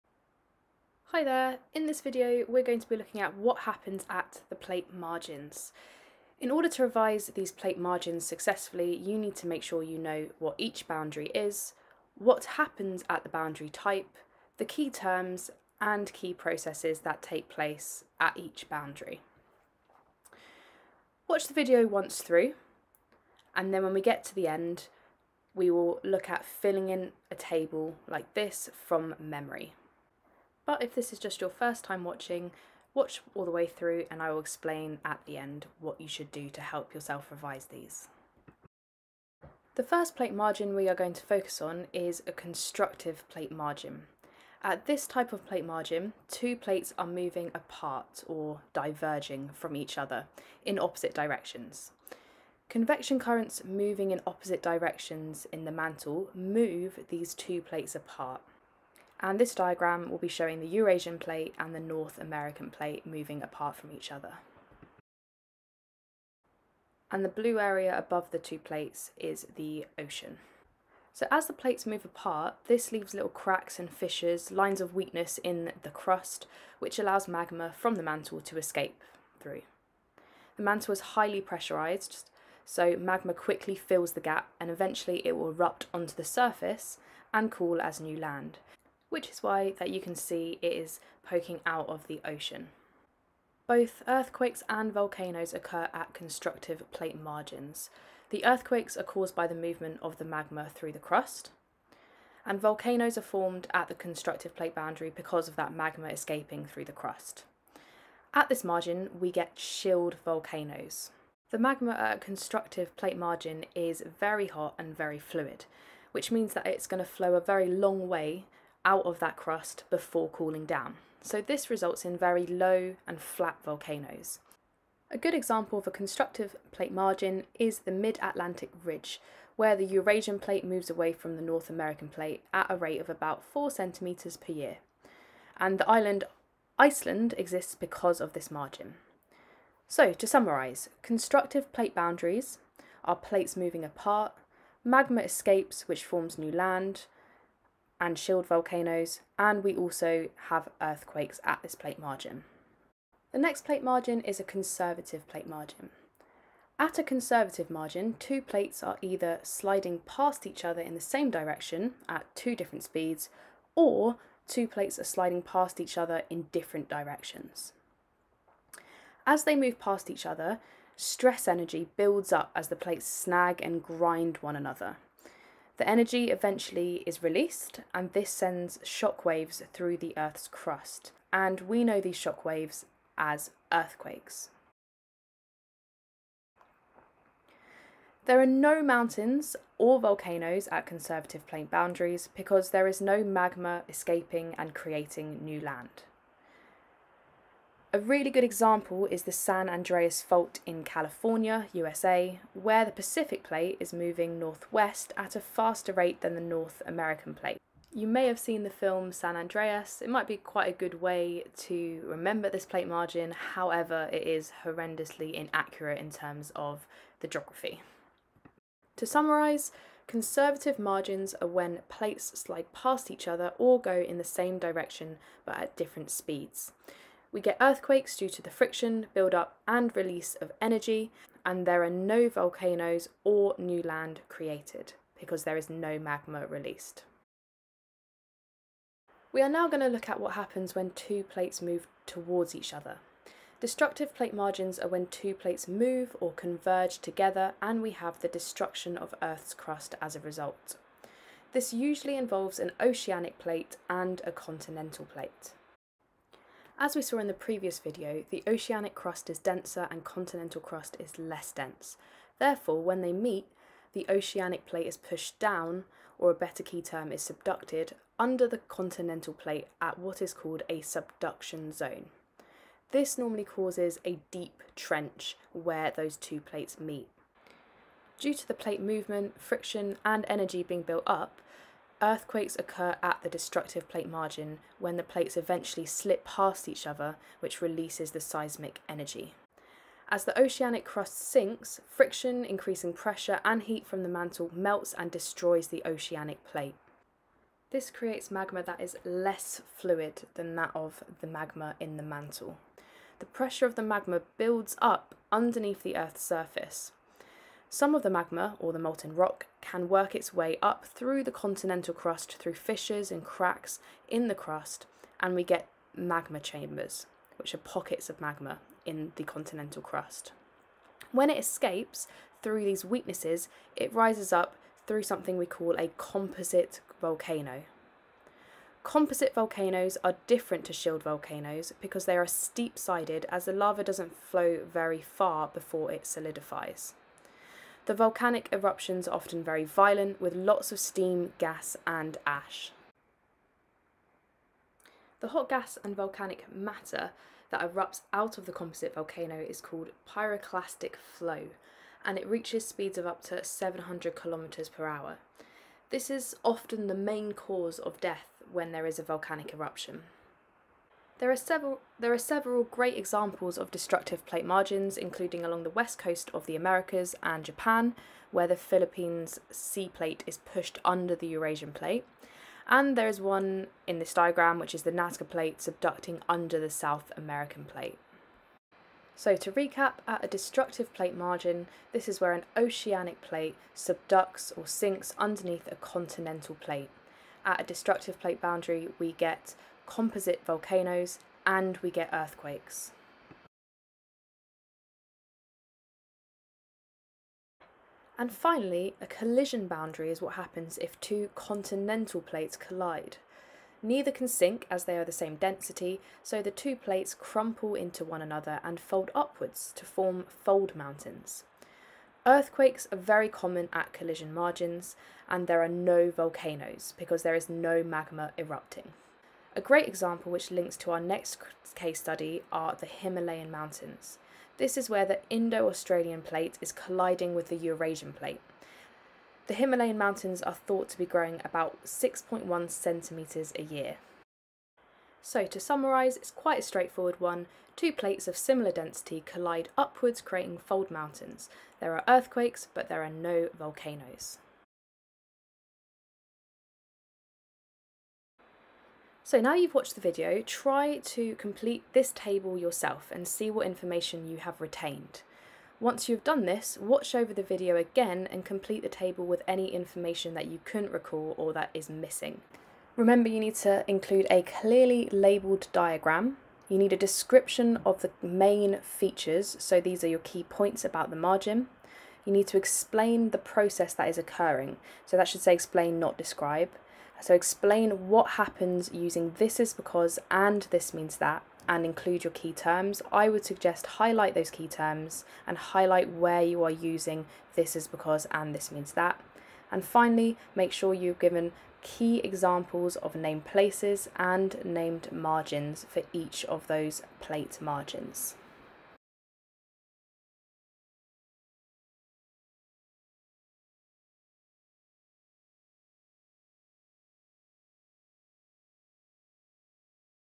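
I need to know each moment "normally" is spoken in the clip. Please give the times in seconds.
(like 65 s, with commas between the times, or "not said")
273 s.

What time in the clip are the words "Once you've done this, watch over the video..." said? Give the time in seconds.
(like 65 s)
455 s.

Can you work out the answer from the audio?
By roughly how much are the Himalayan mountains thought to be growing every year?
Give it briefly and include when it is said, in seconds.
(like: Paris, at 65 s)
6.1 centimetres, at 431 s.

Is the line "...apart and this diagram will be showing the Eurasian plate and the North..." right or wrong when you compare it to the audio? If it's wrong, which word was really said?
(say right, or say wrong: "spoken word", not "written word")
right.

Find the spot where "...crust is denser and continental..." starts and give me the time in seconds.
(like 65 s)
258 s.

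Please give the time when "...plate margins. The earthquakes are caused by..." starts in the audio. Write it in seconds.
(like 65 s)
96 s.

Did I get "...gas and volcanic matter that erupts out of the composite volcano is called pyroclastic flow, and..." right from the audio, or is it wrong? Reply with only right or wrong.
right.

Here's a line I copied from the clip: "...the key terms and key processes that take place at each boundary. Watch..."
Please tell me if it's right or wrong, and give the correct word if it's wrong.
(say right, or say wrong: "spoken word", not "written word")
right.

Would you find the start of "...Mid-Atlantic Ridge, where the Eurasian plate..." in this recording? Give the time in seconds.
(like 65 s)
127 s.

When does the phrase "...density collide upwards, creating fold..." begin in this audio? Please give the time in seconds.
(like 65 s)
438 s.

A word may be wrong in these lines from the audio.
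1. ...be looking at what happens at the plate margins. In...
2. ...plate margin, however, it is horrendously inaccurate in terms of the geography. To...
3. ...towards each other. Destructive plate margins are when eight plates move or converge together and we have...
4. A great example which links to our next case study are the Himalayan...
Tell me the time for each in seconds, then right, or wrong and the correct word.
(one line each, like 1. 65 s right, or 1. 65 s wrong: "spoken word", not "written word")
1. 2 s right
2. 212 s right
3. 242 s wrong: "two", not "eight"
4. 419 s right.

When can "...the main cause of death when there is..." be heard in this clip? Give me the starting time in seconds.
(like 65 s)
356 s.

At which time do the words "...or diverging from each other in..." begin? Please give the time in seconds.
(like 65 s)
48 s.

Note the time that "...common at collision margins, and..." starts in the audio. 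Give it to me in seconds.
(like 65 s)
413 s.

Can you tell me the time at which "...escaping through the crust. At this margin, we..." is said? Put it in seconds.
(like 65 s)
106 s.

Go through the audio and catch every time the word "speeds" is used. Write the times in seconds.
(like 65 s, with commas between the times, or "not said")
162 s, 226 s, 352 s.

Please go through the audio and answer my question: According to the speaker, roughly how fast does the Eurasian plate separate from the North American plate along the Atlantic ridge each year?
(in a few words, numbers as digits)
4 centimetres.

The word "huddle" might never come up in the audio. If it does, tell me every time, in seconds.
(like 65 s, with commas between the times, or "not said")
not said.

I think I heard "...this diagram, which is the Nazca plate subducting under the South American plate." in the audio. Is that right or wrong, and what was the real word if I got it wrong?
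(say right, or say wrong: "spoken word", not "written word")
right.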